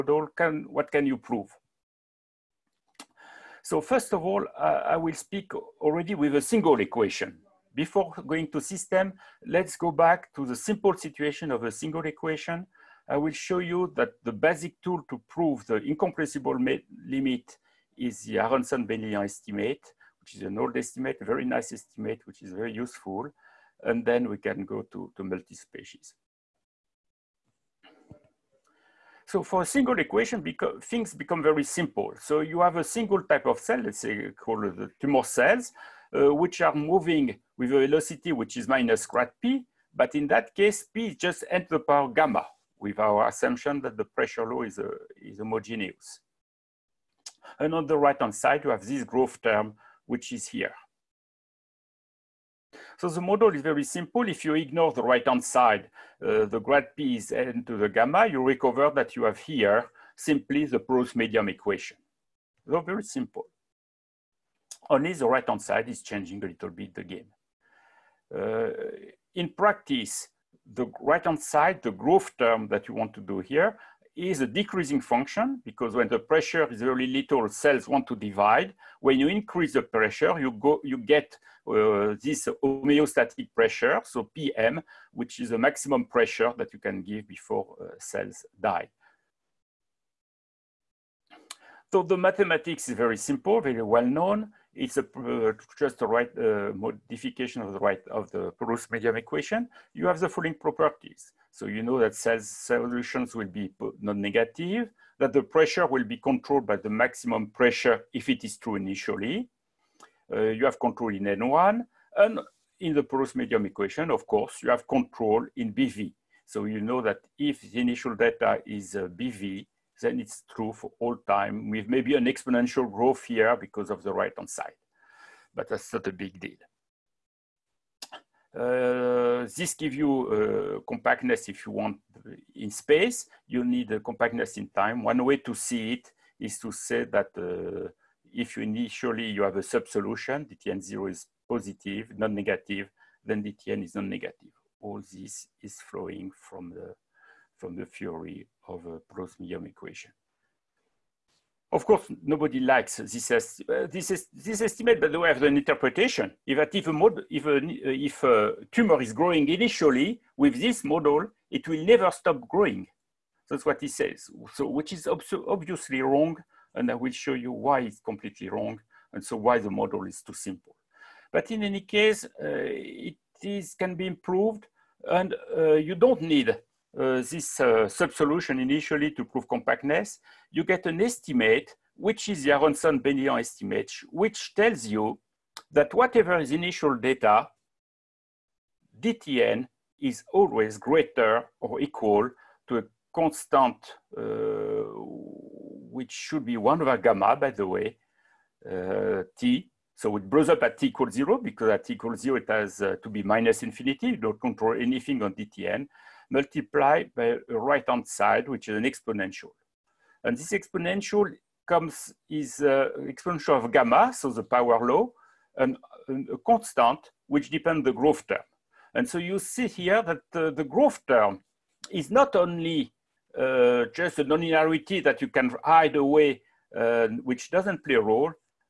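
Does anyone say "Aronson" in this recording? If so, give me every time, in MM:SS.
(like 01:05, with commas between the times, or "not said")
00:18, 03:02.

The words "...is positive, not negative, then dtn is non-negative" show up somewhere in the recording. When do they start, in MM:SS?
02:21.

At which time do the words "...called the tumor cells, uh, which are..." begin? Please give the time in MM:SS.
00:34.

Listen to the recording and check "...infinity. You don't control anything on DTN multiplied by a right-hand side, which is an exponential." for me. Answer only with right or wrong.
right.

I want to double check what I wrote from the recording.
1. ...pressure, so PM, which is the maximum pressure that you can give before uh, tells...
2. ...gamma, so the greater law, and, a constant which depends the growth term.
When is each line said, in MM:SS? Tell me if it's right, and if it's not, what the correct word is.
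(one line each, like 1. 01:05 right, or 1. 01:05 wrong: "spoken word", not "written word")
1. 01:23 wrong: "cells", not "tells"
2. 03:33 wrong: "power", not "greater".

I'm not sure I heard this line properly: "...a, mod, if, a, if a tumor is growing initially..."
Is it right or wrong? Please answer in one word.
right.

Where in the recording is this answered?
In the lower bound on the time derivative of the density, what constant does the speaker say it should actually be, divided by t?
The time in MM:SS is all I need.
03:16.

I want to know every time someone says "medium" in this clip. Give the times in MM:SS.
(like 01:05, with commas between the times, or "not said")
01:01, 01:38, 01:53, 02:29.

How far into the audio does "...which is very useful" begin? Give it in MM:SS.
00:22.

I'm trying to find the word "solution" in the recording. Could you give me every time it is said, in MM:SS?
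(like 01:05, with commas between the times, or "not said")
01:42, 02:19, 02:57.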